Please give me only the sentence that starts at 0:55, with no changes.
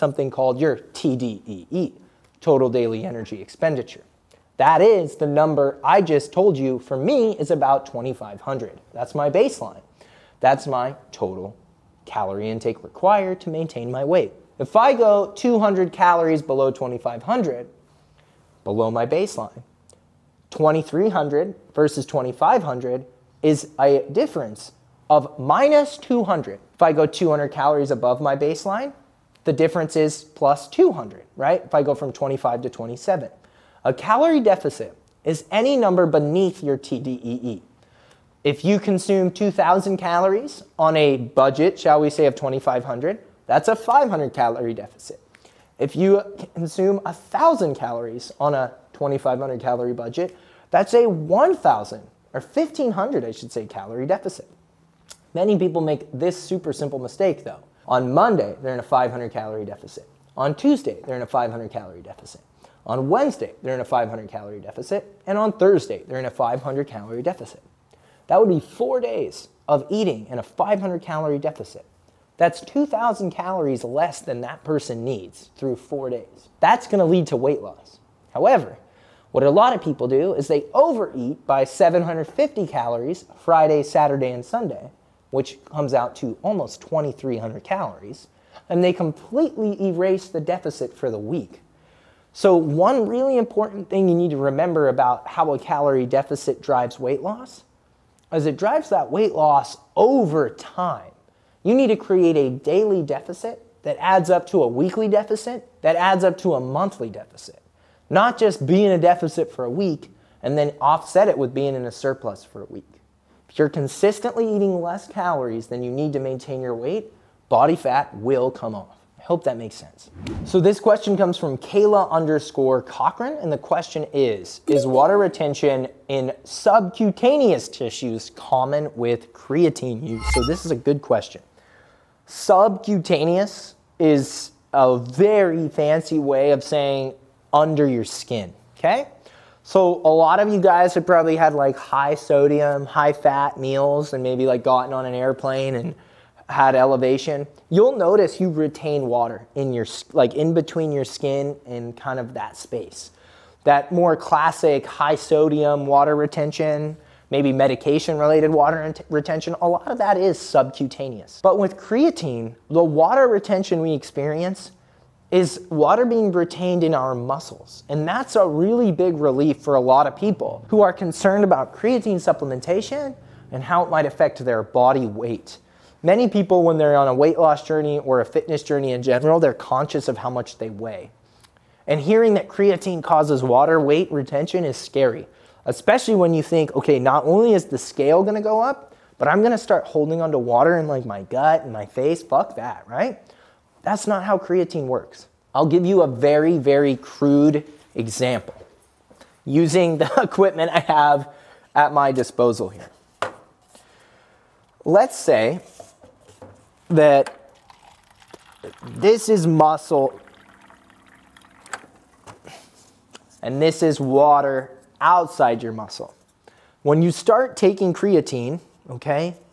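Many people make this super simple mistake though.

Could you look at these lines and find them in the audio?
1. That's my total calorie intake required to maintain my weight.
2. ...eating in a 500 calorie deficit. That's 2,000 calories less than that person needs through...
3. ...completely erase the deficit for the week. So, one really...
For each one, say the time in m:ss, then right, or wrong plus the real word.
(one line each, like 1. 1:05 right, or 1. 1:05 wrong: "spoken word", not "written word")
1. 0:10 right
2. 1:09 right
3. 1:28 right.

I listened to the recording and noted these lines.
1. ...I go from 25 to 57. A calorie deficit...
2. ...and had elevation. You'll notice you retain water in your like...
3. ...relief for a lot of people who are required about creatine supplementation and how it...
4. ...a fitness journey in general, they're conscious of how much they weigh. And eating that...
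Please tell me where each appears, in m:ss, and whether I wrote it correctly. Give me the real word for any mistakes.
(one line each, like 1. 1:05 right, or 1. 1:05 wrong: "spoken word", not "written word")
1. 0:31 wrong: "27", not "57"
2. 2:25 right
3. 2:49 wrong: "concerned", not "required"
4. 2:58 wrong: "hearing", not "eating".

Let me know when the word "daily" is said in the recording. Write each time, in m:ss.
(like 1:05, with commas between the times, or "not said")
0:02, 1:42.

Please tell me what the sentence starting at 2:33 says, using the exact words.
That more classic high sodium water retention, maybe medication related water retention, a lot of that is subcutaneous.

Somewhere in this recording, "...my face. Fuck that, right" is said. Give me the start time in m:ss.
3:11.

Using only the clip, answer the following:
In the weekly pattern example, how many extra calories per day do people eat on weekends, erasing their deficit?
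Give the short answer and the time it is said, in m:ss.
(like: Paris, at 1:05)
750, at 1:21.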